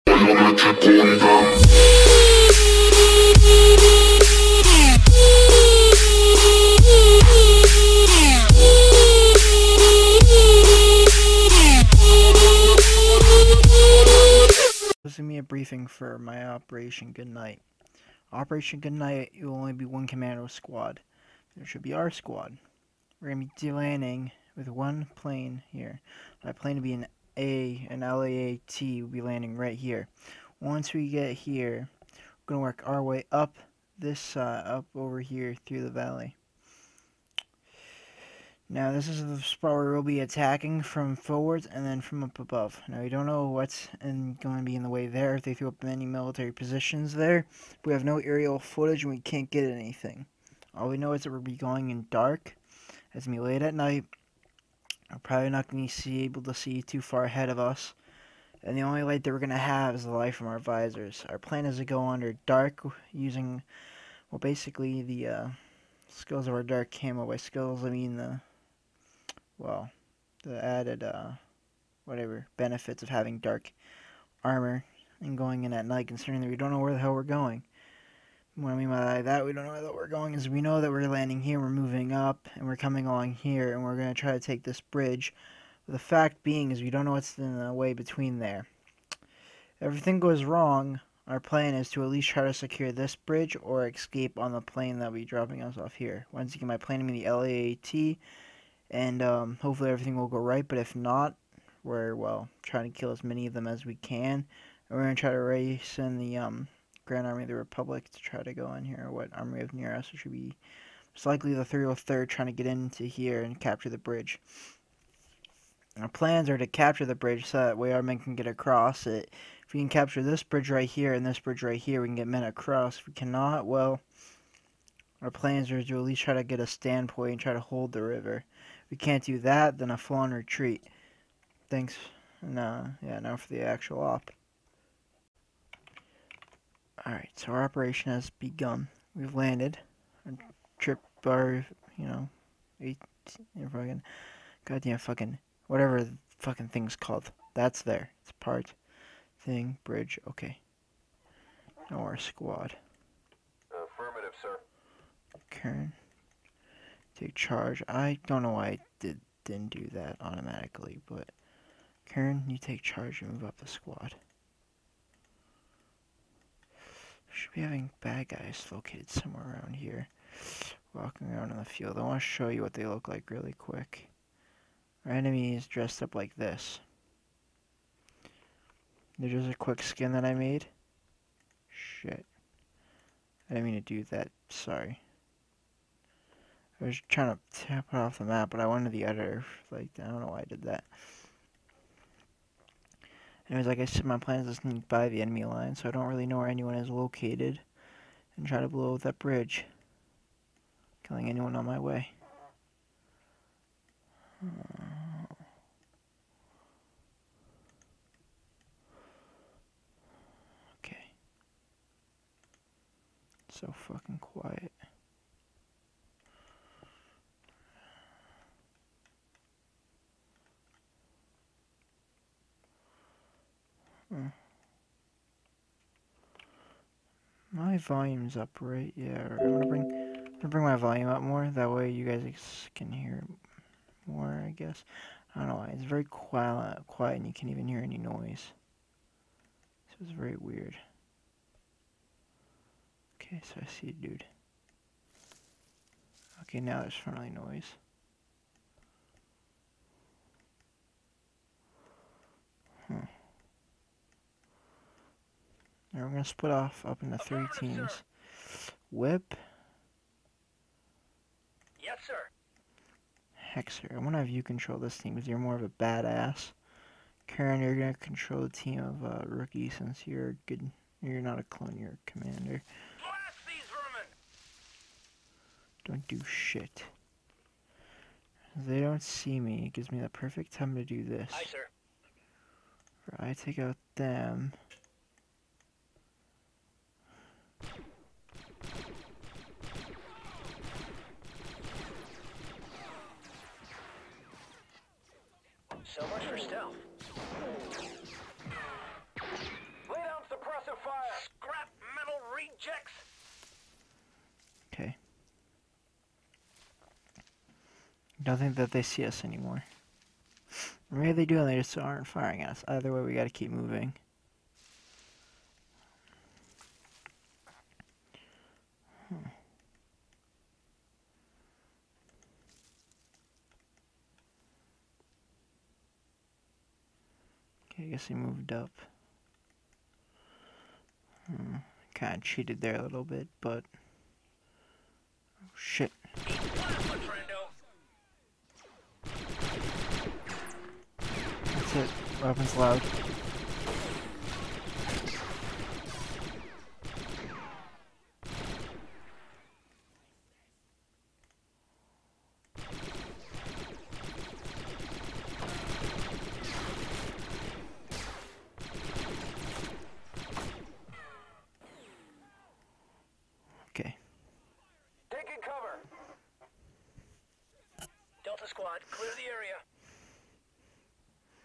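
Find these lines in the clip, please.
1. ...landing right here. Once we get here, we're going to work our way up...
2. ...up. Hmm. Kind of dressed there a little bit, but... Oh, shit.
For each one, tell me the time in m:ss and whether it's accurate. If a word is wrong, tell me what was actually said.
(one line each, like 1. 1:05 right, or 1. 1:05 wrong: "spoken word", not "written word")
1. 0:29 right
2. 5:28 wrong: "cheated", not "dressed".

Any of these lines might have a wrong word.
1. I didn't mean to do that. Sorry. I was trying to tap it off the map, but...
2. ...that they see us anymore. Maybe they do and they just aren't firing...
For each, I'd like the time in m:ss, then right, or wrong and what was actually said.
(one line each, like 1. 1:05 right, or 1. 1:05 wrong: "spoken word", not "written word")
1. 3:03 right
2. 5:08 right.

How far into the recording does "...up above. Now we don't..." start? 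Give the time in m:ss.
0:42.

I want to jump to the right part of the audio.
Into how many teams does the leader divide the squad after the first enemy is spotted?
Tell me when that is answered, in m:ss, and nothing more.
4:17.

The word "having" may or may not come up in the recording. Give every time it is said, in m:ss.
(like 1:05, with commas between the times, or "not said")
1:13, 2:47.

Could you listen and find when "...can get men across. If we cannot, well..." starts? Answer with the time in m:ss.
2:02.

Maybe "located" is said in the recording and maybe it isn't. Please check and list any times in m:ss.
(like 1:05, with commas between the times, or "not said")
2:48, 3:16.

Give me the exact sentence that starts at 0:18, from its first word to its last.
Operation Goodnight, it will only be one commando squad.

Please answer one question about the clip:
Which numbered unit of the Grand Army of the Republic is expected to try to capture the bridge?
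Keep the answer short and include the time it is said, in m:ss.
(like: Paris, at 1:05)
303rd, at 1:51.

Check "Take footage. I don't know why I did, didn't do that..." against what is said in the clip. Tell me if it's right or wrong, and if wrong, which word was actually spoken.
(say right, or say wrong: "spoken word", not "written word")
wrong: "charge", not "footage".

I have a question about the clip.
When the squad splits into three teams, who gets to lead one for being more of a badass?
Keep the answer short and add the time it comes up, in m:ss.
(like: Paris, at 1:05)
Hexer, at 4:23.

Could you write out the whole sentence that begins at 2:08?
If we can't do that, then a full-on retreat.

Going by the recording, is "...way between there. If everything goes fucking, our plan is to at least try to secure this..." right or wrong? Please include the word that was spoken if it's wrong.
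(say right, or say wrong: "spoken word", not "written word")
wrong: "wrong", not "fucking".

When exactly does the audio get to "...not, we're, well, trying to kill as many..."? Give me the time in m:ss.
1:40.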